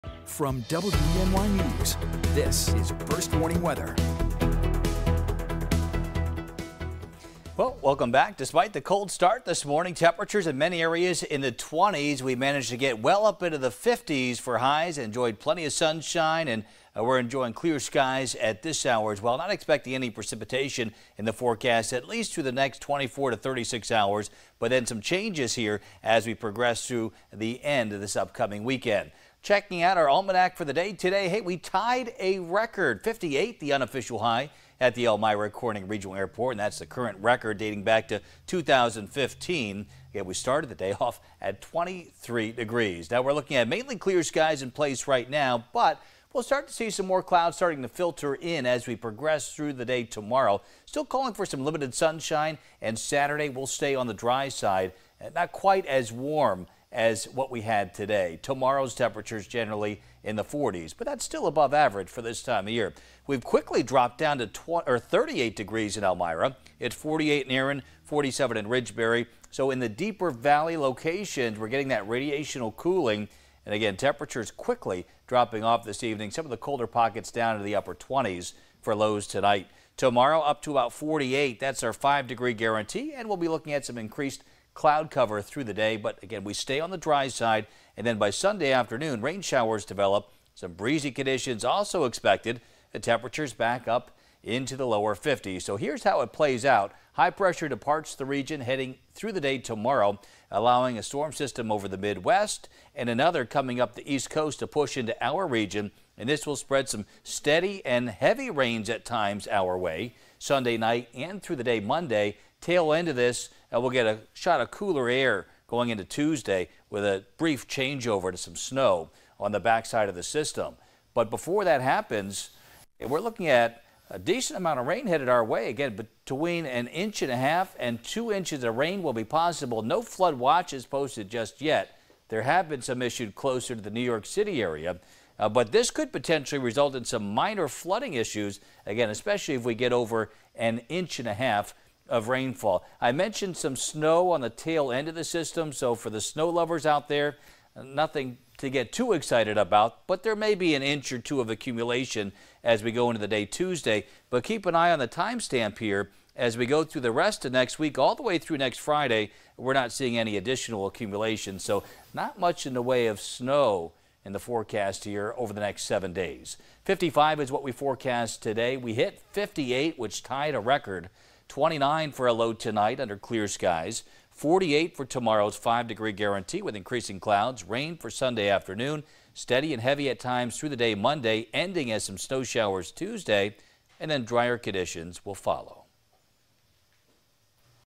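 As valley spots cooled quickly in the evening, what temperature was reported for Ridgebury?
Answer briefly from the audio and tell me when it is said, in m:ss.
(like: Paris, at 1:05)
47, at 1:08.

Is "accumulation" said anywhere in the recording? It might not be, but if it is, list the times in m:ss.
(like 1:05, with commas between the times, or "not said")
2:31, 2:40.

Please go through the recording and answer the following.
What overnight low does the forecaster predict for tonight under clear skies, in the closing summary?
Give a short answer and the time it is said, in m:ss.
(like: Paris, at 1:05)
29, at 2:51.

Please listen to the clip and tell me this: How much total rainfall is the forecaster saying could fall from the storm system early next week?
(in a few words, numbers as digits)
1.5 to 2 inches.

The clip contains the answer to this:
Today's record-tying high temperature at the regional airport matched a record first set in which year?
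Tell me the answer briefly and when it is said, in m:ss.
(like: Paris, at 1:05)
2015, at 0:38.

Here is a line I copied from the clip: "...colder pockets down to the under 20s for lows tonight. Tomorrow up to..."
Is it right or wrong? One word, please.
wrong.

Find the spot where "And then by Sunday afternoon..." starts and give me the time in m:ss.
1:27.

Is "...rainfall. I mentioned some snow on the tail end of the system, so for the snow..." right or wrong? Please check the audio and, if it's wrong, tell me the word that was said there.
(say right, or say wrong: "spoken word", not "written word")
right.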